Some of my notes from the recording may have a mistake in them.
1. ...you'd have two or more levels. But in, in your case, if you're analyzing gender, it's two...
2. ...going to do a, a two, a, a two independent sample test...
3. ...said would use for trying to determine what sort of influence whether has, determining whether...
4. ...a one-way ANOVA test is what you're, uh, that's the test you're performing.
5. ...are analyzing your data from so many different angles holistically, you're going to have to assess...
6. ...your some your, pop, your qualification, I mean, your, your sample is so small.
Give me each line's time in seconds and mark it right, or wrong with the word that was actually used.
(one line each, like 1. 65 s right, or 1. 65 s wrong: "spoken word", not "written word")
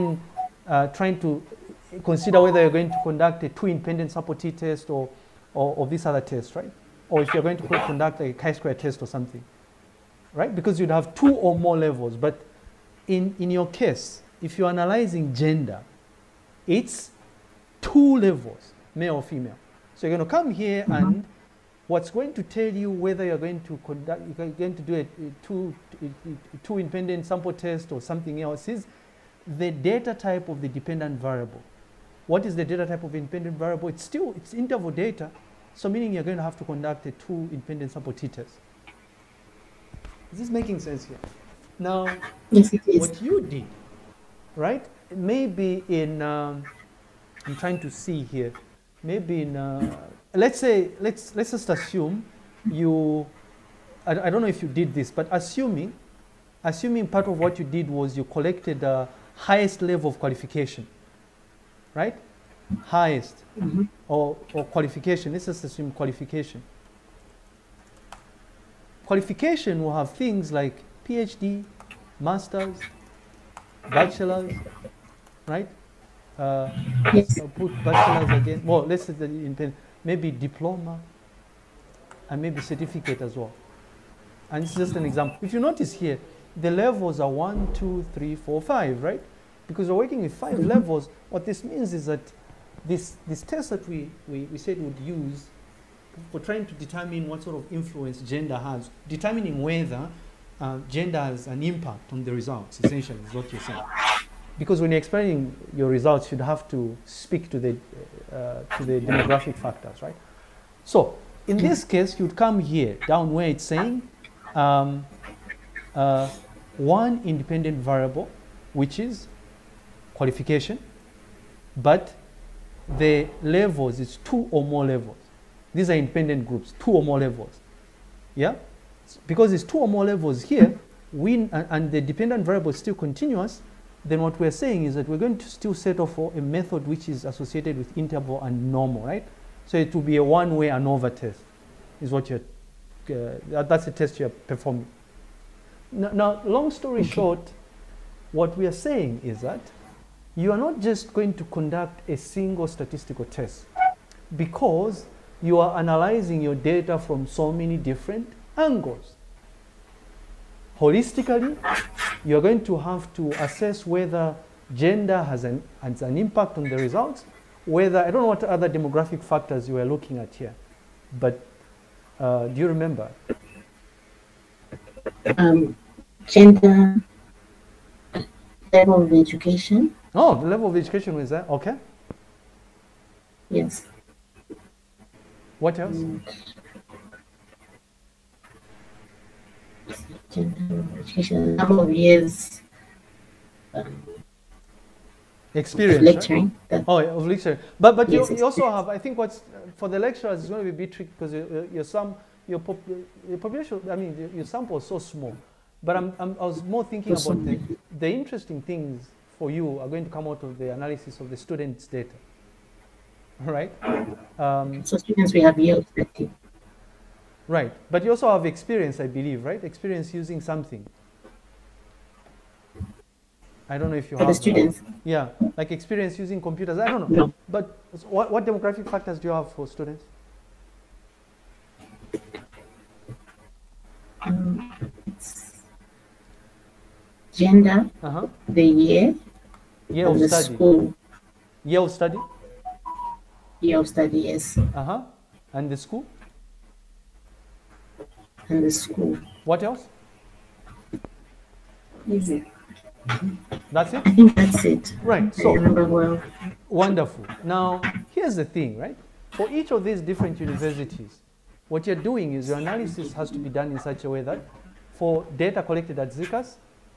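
1. 10 s right
2. 24 s right
3. 94 s wrong: "gender", not "whether"
4. 140 s right
5. 155 s right
6. 201 s wrong: "population", not "qualification".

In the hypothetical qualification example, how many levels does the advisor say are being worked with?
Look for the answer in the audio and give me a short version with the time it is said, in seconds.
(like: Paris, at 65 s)
5, at 90 s.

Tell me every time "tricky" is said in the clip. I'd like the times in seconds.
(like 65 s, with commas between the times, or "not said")
200 s.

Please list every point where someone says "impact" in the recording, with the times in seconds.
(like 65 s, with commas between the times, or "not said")
101 s, 166 s.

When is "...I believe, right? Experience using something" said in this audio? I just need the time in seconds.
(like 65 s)
218 s.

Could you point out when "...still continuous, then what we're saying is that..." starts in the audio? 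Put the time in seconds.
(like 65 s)
132 s.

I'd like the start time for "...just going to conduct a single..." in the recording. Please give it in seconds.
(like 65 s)
150 s.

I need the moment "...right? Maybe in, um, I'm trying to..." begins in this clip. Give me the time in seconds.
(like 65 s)
44 s.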